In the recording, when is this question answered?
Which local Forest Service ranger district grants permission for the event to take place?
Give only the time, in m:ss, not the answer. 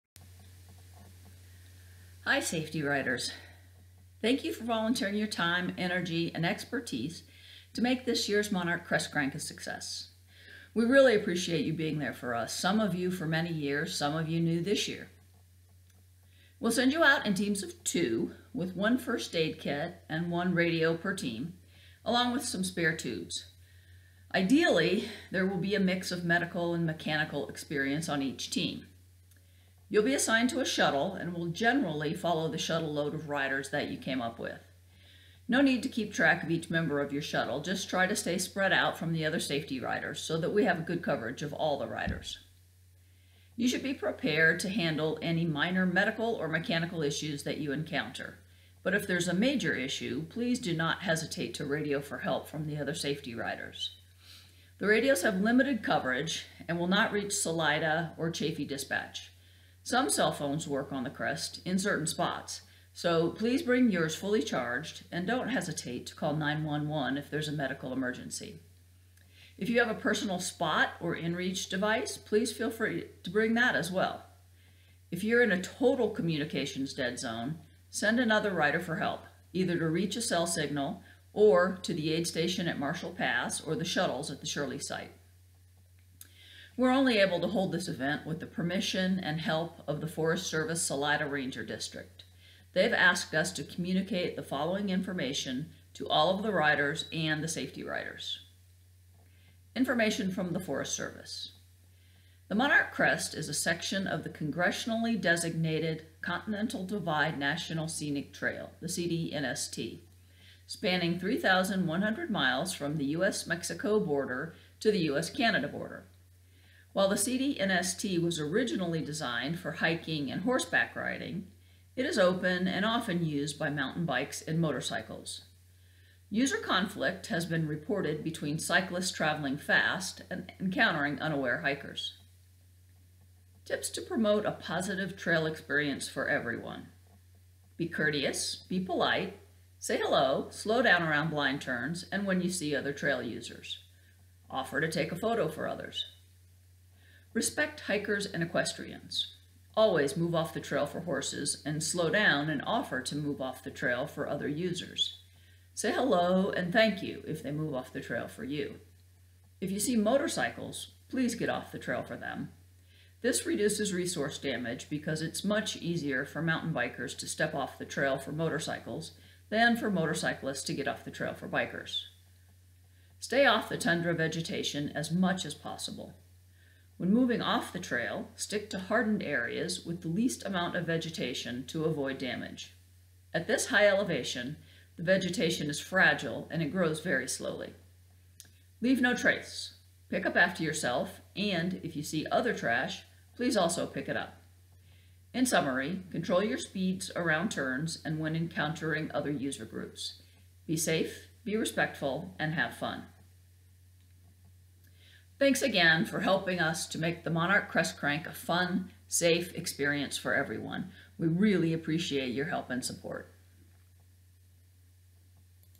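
1:30.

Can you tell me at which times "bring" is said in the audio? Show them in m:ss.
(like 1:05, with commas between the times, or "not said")
1:03, 1:13.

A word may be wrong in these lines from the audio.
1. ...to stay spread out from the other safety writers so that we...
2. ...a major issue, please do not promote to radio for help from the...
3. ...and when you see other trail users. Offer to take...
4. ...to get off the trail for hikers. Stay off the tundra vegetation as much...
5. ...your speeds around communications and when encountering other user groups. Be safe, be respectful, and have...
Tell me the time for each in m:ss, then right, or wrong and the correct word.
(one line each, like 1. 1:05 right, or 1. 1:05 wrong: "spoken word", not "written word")
1. 0:38 wrong: "riders", not "writers"
2. 0:49 wrong: "hesitate", not "promote"
3. 2:22 right
4. 2:50 wrong: "bikers", not "hikers"
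5. 3:16 wrong: "turns", not "communications".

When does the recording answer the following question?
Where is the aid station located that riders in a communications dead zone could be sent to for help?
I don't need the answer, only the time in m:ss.
1:22.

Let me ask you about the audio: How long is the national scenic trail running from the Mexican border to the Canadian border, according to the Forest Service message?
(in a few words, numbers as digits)
3,100 miles.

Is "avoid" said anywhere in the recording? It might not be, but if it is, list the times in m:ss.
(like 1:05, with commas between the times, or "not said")
3:01.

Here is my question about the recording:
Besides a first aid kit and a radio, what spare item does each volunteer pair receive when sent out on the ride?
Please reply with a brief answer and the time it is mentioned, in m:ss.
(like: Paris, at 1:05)
spare tubes, at 0:22.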